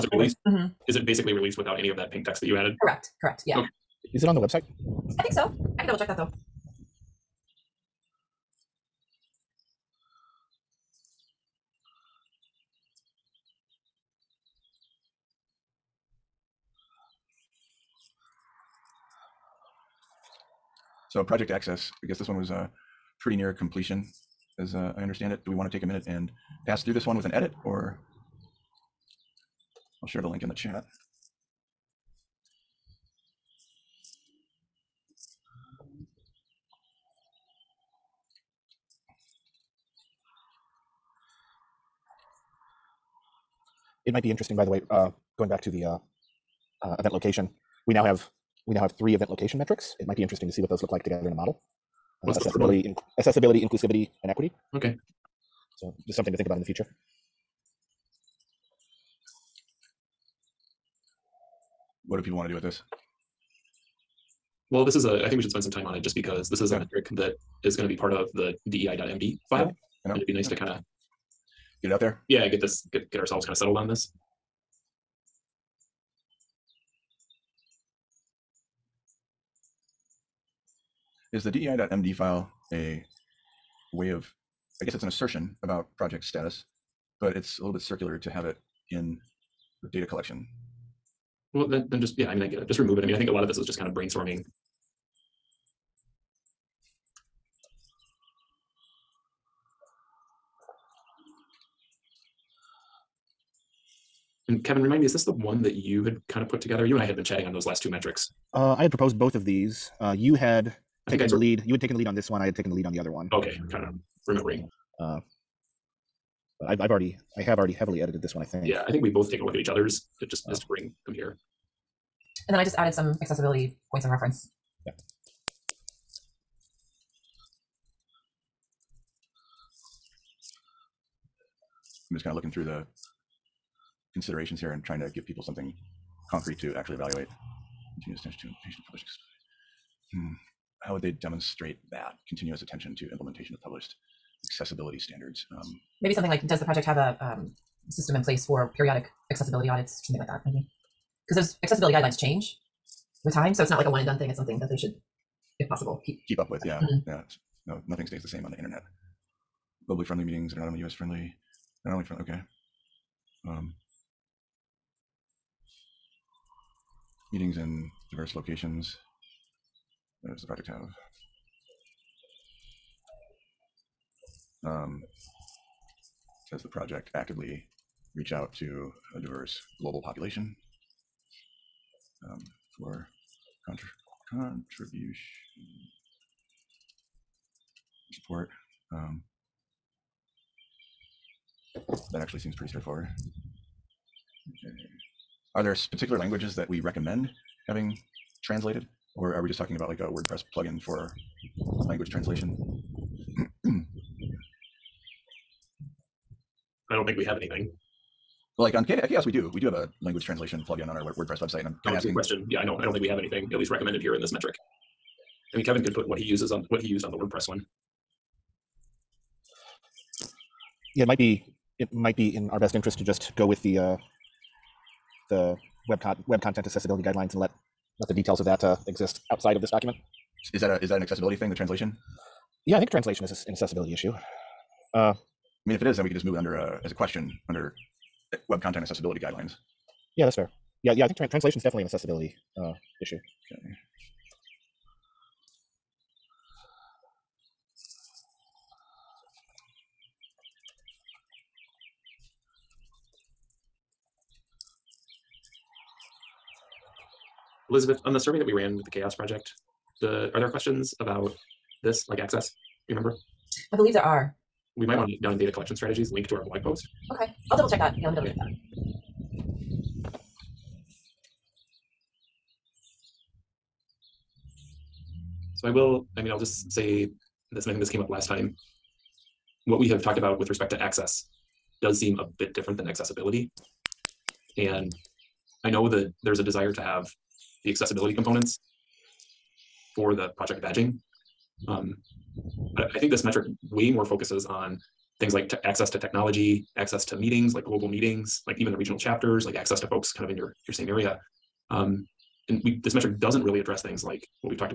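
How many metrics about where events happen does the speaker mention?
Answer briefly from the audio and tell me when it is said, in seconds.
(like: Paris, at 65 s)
3, at 48 s.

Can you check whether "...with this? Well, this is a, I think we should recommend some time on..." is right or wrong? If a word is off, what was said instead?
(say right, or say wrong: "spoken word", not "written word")
wrong: "spend", not "recommend".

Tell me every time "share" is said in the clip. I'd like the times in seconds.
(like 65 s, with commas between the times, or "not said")
30 s.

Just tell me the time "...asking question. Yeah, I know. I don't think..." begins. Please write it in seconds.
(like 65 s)
211 s.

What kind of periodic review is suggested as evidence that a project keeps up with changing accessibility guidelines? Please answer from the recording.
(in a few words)
accessibility audits.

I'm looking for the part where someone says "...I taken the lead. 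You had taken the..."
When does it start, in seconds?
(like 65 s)
111 s.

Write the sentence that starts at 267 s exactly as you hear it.
Yeah, let me double check that.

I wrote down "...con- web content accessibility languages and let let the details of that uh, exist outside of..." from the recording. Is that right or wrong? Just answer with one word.
wrong.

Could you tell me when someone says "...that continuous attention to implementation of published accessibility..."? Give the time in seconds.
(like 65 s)
141 s.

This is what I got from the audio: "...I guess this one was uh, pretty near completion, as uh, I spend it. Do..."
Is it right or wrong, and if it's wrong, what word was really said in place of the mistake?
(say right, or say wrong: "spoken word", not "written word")
wrong: "understand", not "spend".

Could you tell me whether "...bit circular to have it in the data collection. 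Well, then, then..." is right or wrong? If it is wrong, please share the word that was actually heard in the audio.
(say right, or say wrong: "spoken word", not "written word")
right.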